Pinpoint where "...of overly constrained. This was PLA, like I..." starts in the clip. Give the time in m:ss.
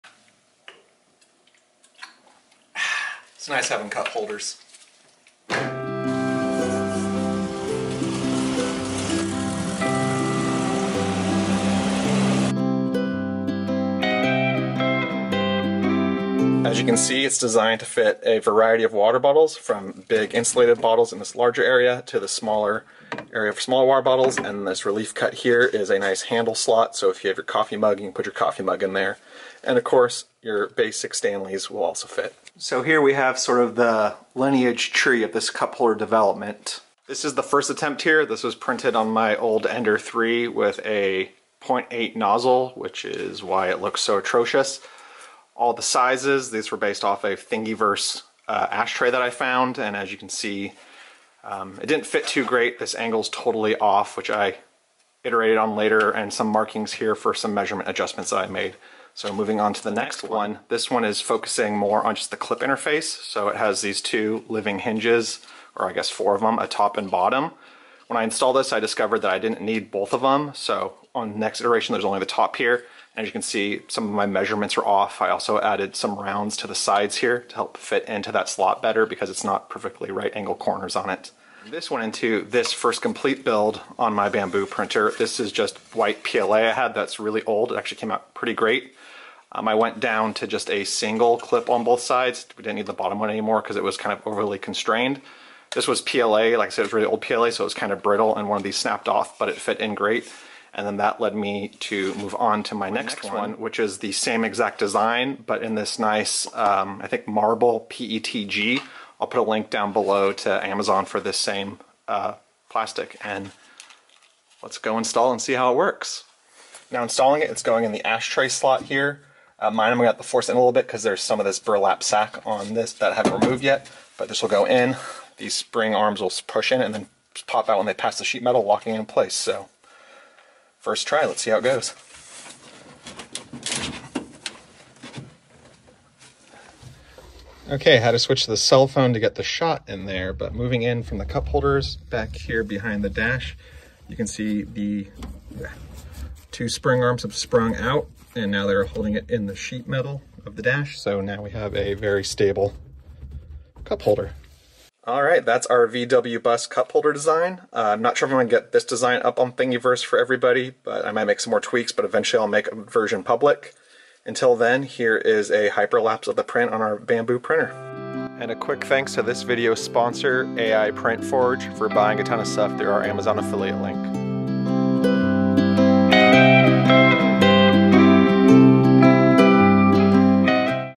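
1:34.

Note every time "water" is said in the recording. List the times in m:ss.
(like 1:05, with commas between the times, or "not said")
0:18, 0:23.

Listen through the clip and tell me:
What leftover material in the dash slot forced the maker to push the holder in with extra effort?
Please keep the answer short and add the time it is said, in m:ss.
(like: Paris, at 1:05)
burlap sack, at 2:01.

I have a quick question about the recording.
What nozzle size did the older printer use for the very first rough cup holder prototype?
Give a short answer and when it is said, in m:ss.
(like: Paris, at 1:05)
0.8, at 0:41.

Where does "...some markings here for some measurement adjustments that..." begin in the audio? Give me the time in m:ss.
0:56.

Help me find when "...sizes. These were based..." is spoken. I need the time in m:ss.
0:45.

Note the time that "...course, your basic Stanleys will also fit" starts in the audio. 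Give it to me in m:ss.
0:29.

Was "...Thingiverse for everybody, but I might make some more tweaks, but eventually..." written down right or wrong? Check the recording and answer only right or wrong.
right.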